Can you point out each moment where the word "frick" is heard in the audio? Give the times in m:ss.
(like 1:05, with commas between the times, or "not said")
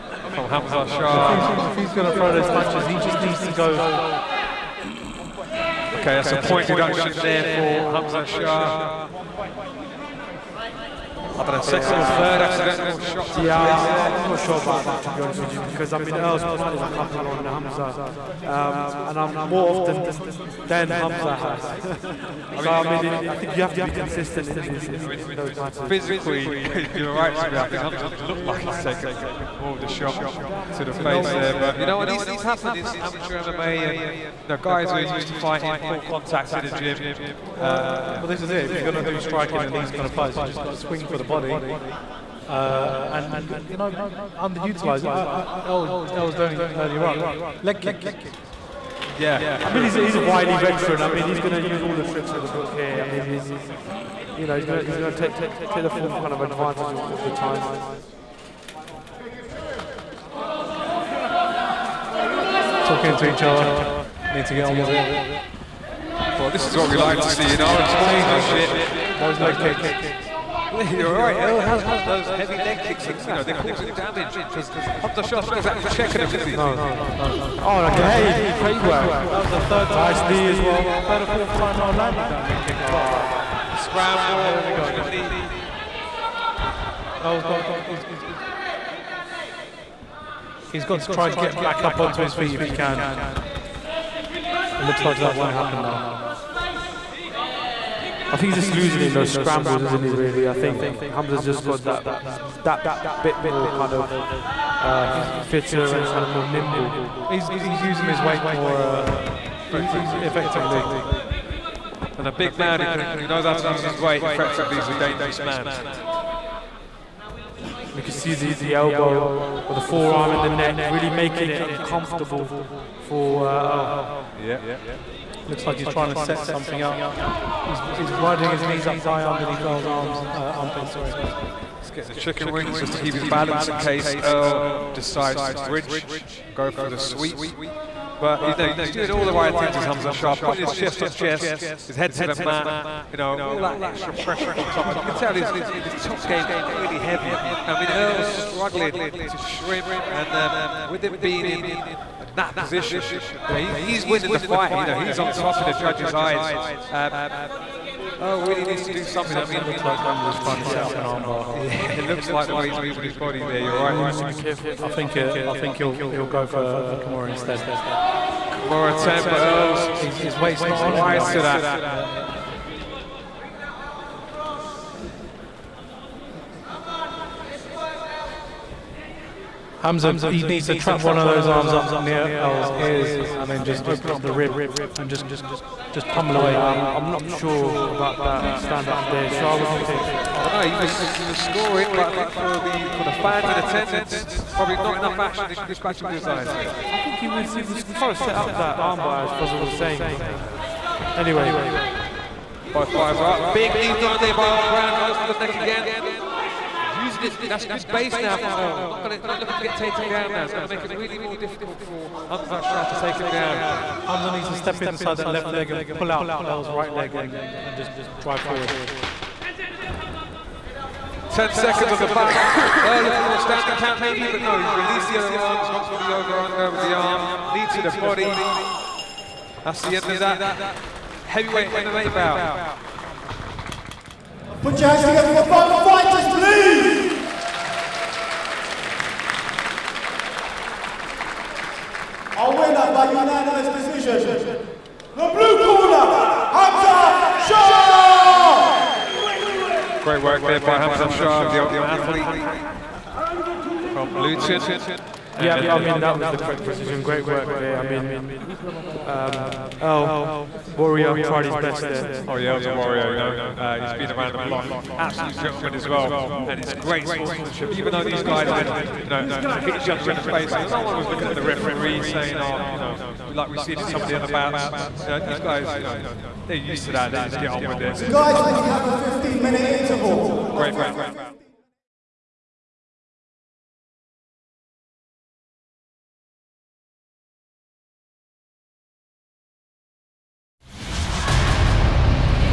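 not said.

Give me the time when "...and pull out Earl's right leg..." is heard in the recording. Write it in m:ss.
3:35.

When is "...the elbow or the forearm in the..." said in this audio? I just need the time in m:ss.
1:58.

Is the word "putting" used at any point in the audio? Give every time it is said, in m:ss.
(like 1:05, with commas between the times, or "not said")
2:20.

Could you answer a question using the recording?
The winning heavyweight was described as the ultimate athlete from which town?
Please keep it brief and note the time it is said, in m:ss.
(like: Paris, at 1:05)
Luton, at 4:14.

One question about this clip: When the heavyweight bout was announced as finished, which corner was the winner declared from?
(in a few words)
Blue corner.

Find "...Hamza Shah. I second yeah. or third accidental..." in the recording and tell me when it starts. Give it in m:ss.
0:07.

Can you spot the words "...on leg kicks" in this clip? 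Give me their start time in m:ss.
0:47.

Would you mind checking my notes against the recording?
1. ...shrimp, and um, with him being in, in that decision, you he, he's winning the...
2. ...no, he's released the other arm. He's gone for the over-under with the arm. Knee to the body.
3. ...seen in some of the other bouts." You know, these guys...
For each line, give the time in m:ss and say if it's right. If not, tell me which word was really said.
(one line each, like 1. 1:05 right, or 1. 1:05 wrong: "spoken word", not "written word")
1. 2:29 wrong: "position", not "decision"
2. 3:44 right
3. 4:33 right.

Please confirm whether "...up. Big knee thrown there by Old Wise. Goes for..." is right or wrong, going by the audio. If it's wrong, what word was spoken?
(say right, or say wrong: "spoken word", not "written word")
wrong: "Brown", not "Wise".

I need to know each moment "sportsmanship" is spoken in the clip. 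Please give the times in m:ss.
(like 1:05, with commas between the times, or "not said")
1:07, 4:27.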